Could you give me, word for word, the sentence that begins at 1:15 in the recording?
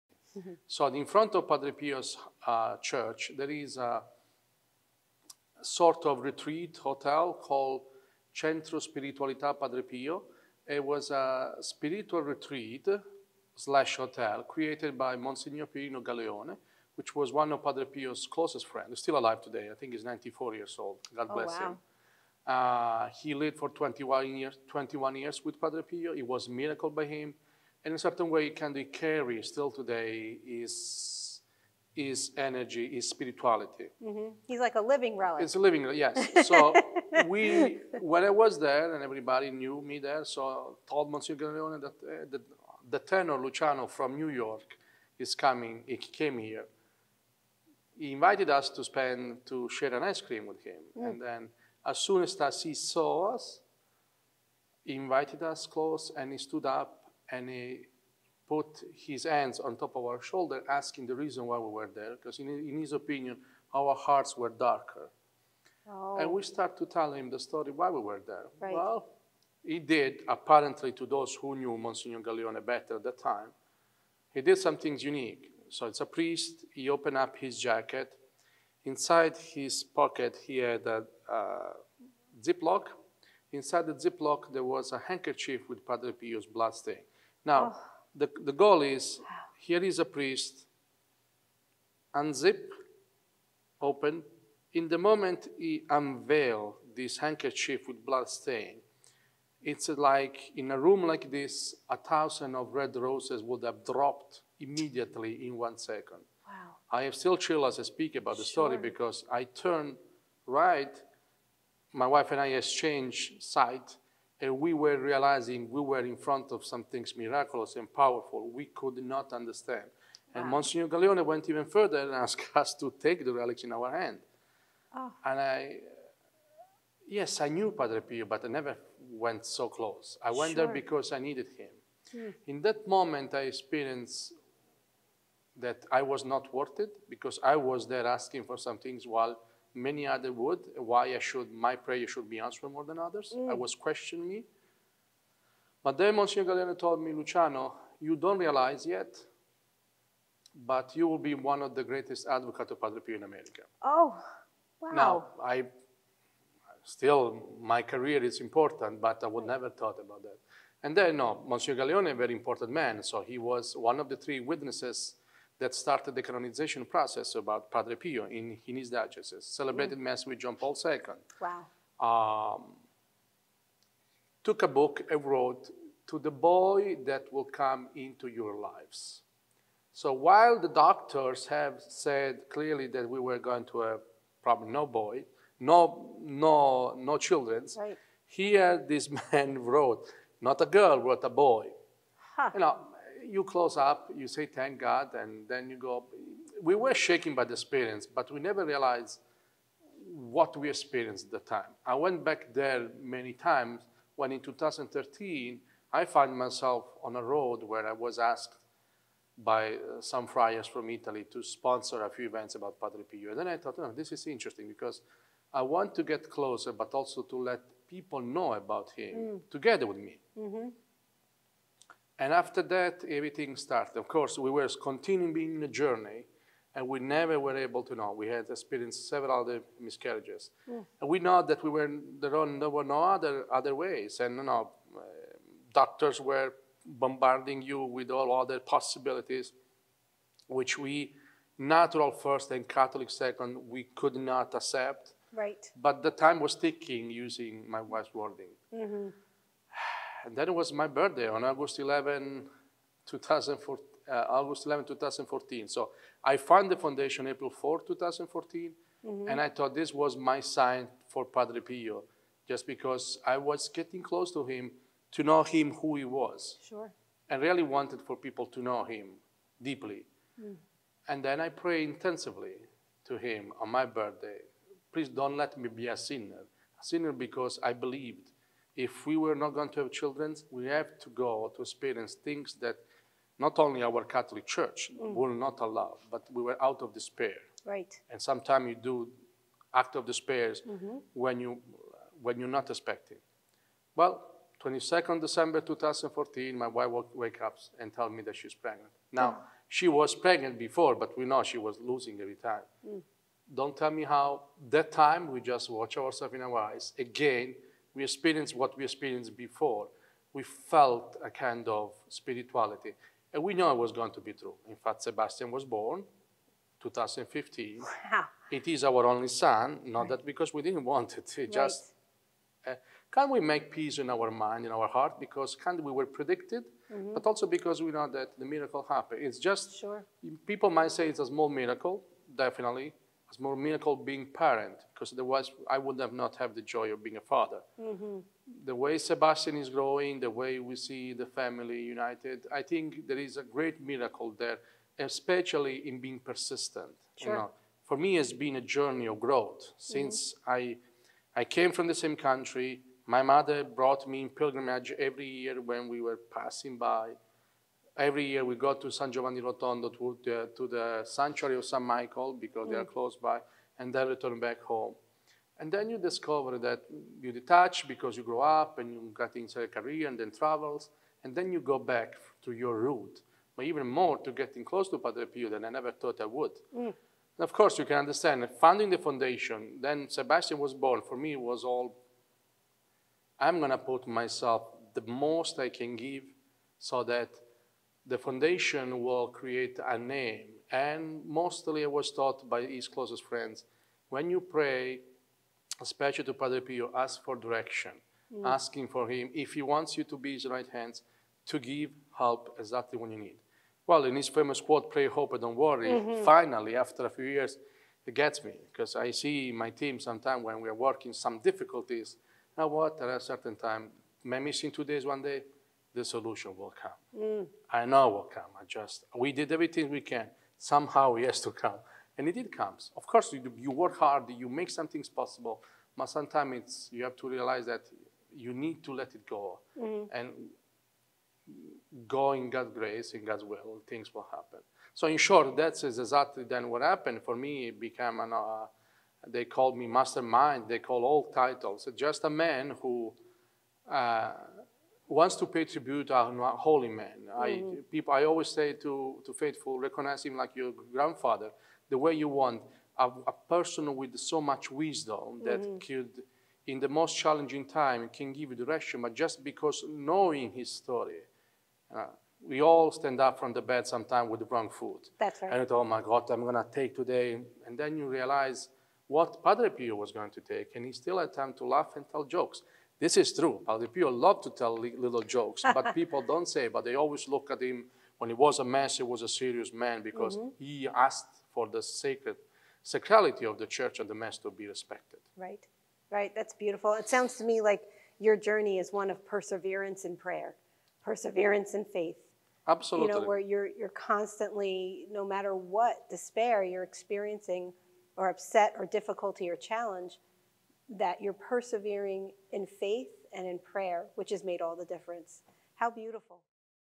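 So it's a priest, he opened up his jacket.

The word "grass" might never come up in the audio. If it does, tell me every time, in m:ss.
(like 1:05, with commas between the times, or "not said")
not said.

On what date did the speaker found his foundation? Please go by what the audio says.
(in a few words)
April 4, 2014.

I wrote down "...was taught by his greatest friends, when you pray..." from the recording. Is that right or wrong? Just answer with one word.
wrong.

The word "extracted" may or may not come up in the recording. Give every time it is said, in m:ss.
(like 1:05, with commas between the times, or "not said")
not said.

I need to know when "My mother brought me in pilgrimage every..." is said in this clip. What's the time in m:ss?
5:53.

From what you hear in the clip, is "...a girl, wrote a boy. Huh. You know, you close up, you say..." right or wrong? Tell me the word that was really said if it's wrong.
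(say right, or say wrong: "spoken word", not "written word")
right.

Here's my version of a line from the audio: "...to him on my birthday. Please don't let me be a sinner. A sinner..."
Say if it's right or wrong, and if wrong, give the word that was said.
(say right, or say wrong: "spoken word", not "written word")
right.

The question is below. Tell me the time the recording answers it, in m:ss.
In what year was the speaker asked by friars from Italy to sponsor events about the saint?
3:24.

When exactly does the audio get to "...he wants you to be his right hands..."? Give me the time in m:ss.
6:39.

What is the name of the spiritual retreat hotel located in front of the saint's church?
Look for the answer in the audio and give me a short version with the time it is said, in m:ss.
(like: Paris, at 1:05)
Centro Spiritualità Padre Pio, at 0:08.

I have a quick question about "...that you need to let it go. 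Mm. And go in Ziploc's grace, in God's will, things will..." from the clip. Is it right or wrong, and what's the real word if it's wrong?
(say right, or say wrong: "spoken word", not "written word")
wrong: "God", not "Ziploc".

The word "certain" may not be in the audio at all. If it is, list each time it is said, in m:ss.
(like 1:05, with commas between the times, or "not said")
0:27, 6:53.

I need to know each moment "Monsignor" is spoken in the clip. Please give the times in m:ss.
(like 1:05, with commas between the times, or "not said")
0:15, 0:41, 1:11, 2:00, 2:26, 2:41.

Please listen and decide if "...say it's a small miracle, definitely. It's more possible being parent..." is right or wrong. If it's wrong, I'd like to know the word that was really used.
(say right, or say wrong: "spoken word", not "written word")
wrong: "miracle", not "possible".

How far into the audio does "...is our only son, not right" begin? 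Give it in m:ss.
5:18.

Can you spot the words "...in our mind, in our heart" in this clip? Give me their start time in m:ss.
5:23.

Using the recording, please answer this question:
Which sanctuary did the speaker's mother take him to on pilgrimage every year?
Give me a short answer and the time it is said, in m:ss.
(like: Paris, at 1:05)
San Michael, at 6:01.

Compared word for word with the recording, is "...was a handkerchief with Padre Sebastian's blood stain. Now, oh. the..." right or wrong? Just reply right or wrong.
wrong.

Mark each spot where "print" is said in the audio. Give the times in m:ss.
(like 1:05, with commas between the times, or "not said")
not said.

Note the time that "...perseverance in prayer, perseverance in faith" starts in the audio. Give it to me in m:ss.
8:09.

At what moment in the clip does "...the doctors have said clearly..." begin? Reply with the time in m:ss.
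3:00.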